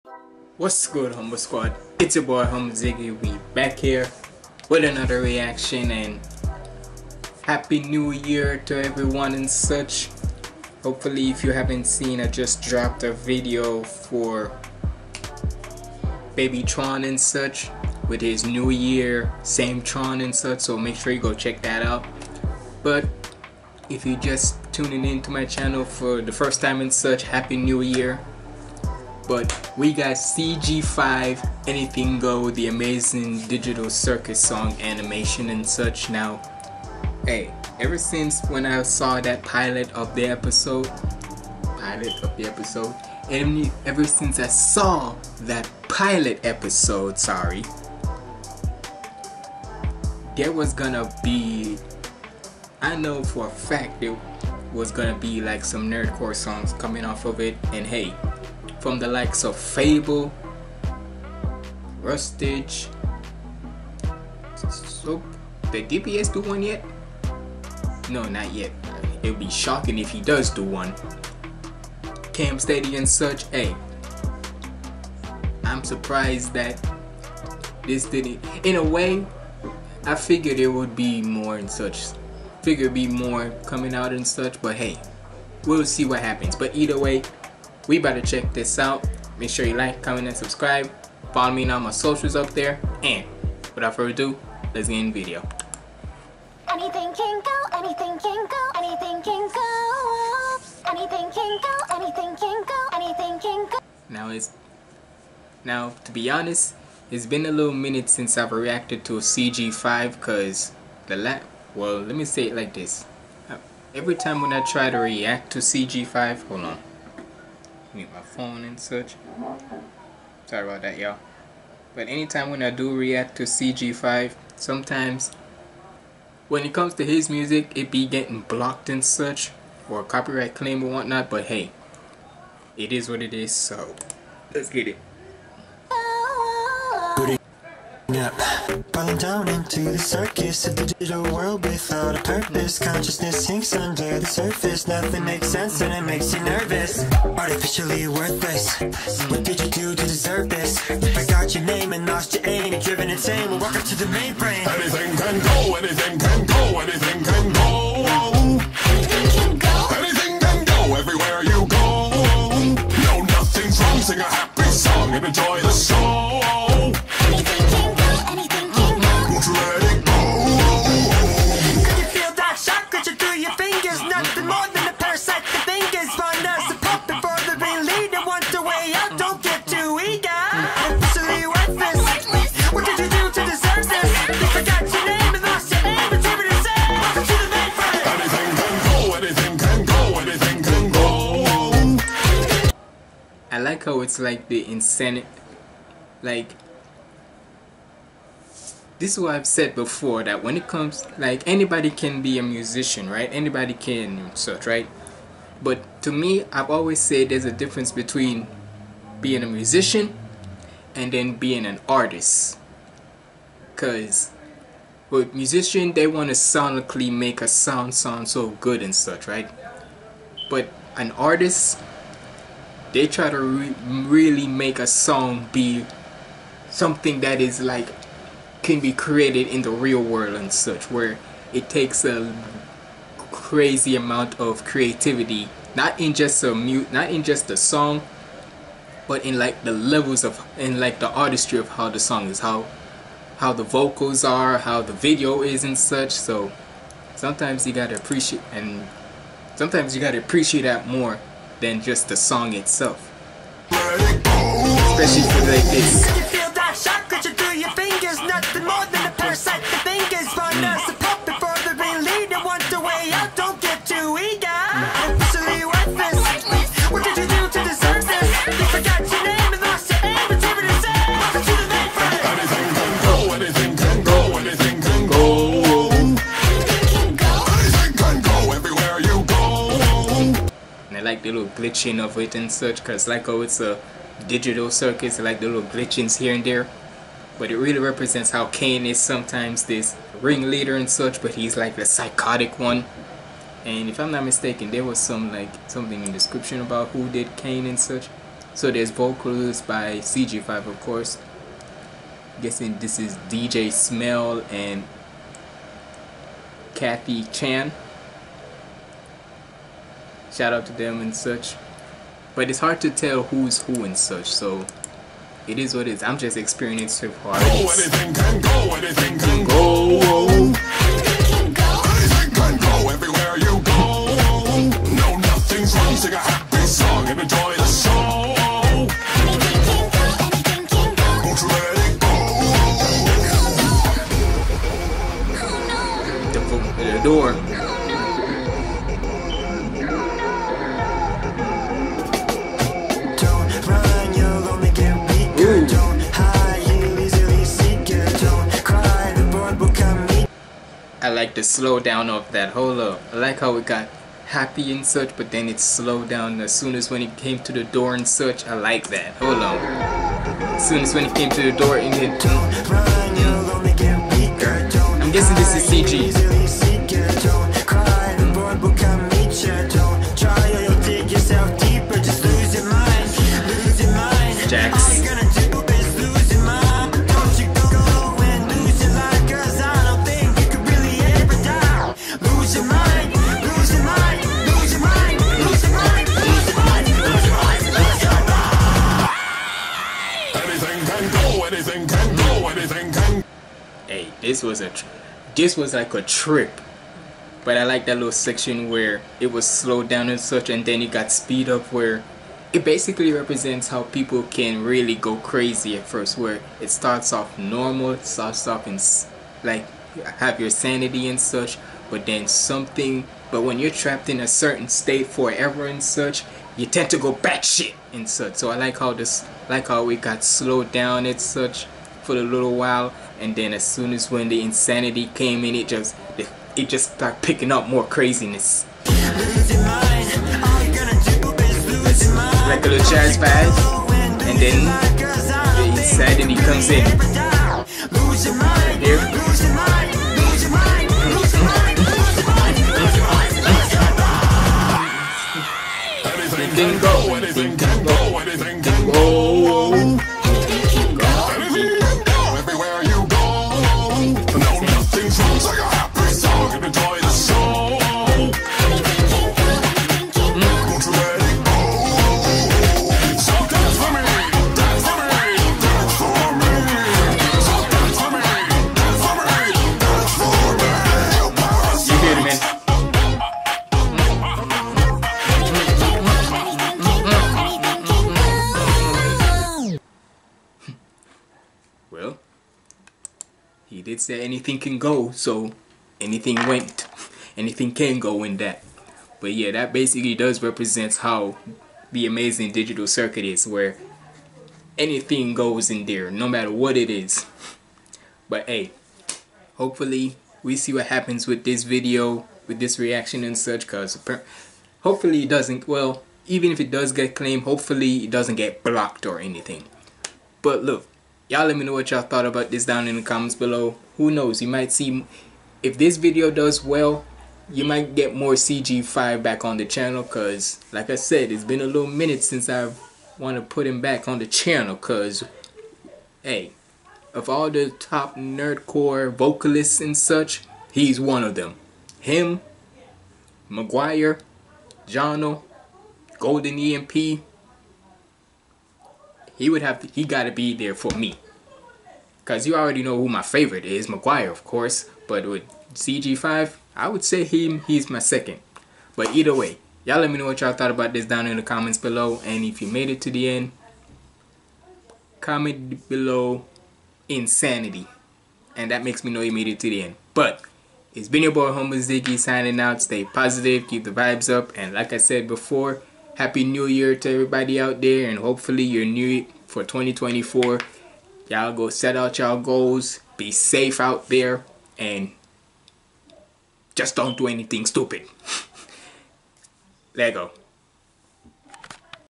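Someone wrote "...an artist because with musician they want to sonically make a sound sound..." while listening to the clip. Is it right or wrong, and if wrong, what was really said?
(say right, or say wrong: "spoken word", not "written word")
right.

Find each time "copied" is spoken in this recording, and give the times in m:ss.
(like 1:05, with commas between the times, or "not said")
not said.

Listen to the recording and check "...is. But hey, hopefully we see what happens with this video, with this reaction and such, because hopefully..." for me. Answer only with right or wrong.
right.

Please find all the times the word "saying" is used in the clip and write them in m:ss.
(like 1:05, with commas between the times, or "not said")
not said.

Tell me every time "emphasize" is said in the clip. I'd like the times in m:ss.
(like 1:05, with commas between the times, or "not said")
not said.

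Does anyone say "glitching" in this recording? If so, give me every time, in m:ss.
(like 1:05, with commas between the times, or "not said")
4:41, 4:45.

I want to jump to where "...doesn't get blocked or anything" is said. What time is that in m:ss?
8:28.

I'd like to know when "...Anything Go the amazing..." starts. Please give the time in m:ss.
0:31.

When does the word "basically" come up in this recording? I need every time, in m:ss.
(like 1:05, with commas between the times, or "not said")
6:42, 8:09.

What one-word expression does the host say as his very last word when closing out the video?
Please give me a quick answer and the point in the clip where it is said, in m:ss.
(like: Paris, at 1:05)
Lego, at 9:39.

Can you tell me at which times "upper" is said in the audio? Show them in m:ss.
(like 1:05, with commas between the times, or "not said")
not said.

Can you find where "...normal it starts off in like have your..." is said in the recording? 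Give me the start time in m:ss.
6:47.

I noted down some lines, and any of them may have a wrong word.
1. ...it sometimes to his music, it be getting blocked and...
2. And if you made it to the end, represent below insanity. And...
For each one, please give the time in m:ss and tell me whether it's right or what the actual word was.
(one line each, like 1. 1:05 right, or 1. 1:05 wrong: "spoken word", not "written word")
1. 2:06 wrong: "comes", not "sometimes"
2. 9:12 wrong: "comment", not "represent".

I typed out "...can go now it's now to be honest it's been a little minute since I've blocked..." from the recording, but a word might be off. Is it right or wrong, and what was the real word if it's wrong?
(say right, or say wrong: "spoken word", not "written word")
wrong: "reacted", not "blocked".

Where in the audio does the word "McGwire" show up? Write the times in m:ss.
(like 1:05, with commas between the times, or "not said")
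8:53, 9:03.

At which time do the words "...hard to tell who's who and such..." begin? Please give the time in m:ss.
5:12.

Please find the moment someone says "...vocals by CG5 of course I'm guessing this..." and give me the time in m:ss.
4:58.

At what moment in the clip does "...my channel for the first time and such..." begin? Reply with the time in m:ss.
0:25.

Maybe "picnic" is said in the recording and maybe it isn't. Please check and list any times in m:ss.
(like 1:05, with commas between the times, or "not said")
not said.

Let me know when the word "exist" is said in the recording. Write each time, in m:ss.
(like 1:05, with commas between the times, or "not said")
not said.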